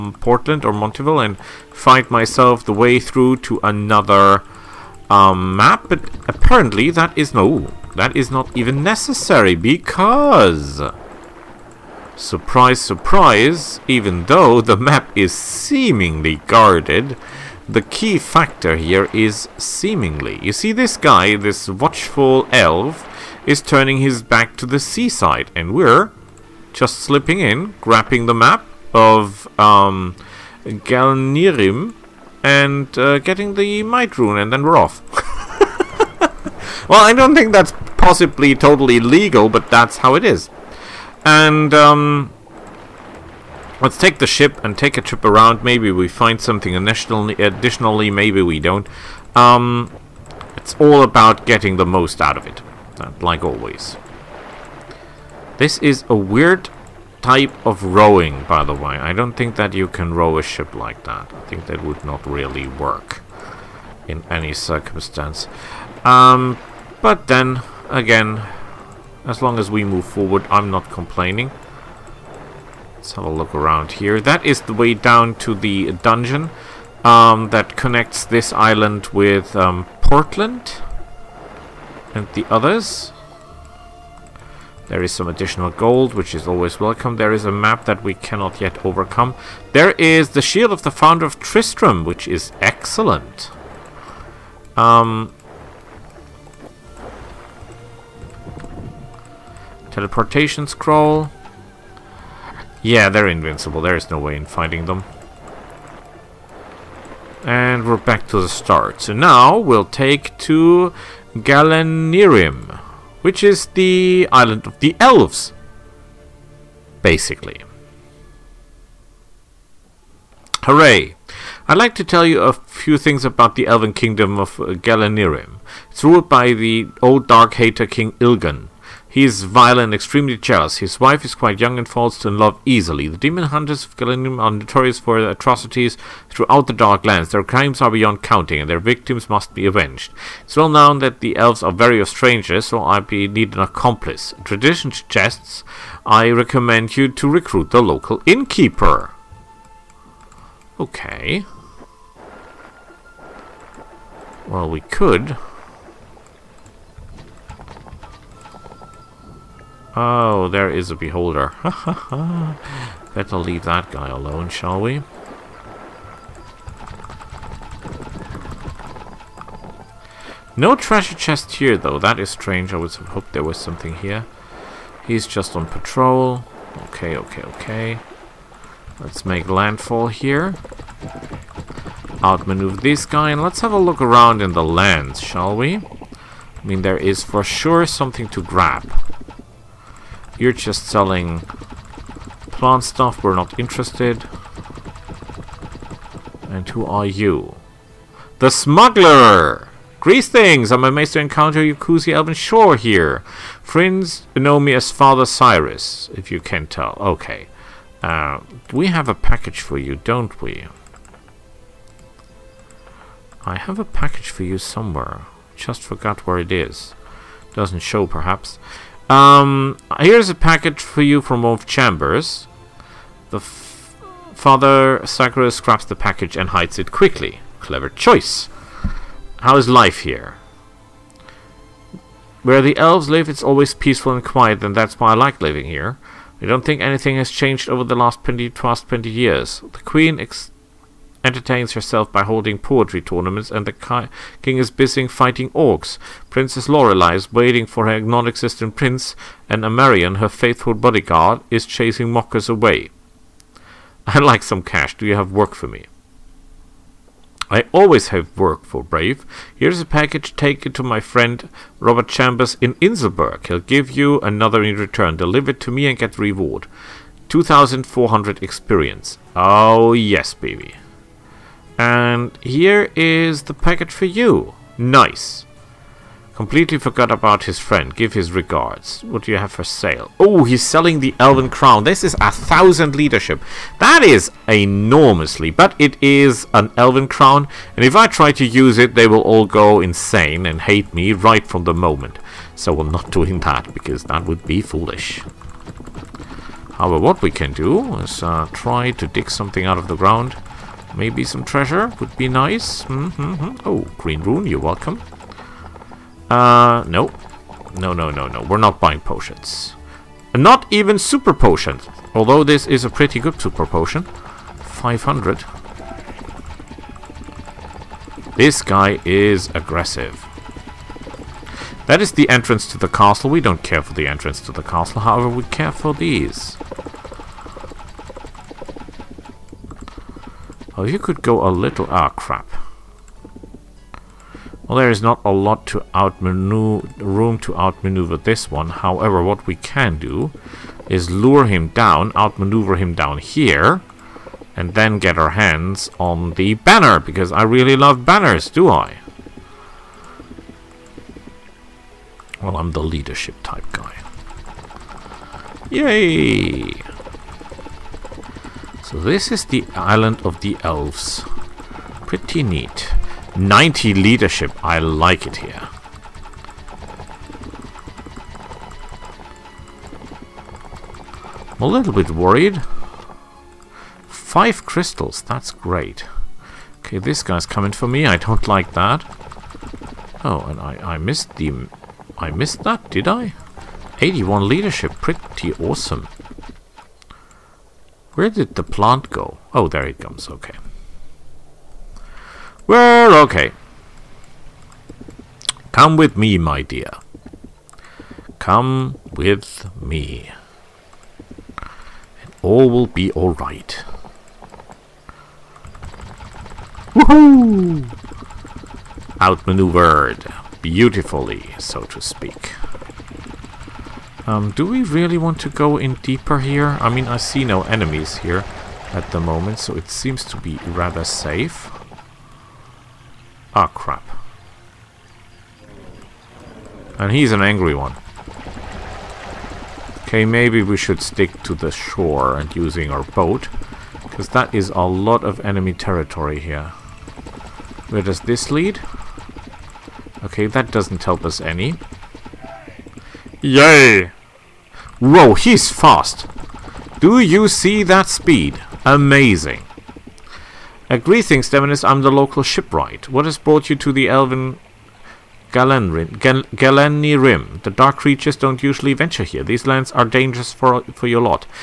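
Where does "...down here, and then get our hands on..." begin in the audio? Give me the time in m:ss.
5:42.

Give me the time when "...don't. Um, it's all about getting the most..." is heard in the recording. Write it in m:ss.
0:48.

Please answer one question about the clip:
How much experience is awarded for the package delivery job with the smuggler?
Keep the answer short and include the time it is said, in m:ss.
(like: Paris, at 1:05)
2400, at 4:27.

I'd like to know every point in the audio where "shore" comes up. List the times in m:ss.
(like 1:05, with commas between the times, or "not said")
3:22, 7:11.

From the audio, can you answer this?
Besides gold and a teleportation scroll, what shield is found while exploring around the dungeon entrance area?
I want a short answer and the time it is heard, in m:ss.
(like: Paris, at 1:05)
Shield of the Founder of Tristram, at 1:30.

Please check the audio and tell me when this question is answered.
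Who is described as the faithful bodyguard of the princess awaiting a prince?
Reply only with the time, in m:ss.
4:09.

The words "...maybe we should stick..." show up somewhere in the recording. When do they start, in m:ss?
7:10.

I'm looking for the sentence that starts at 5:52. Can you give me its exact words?
Well, I'm the leadership type guy.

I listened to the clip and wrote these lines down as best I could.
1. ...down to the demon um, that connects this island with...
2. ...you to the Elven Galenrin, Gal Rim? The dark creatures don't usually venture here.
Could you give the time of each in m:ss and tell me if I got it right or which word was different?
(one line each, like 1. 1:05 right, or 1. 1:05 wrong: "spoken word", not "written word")
1. 1:14 wrong: "dungeon", not "demon"
2. 7:33 right.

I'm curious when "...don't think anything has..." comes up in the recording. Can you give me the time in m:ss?
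3:56.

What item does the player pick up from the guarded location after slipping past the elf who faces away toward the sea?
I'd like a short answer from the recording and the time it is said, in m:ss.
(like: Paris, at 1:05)
Might Rune, at 0:33.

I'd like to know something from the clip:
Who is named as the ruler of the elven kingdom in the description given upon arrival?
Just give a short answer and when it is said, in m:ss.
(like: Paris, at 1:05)
King Ilgan, at 2:07.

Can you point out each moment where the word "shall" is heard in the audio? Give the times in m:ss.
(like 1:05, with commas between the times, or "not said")
2:44, 3:05.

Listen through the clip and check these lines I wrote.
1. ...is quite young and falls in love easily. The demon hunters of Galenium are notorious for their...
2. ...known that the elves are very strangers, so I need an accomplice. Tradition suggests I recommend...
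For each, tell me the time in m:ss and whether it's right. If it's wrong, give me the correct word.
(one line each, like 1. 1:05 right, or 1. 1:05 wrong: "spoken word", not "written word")
1. 2:11 right
2. 2:20 right.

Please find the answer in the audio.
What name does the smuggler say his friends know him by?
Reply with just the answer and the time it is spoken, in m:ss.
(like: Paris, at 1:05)
Father Cyrus, at 3:24.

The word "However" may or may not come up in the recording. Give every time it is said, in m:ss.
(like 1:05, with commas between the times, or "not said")
4:56, 5:25, 5:38.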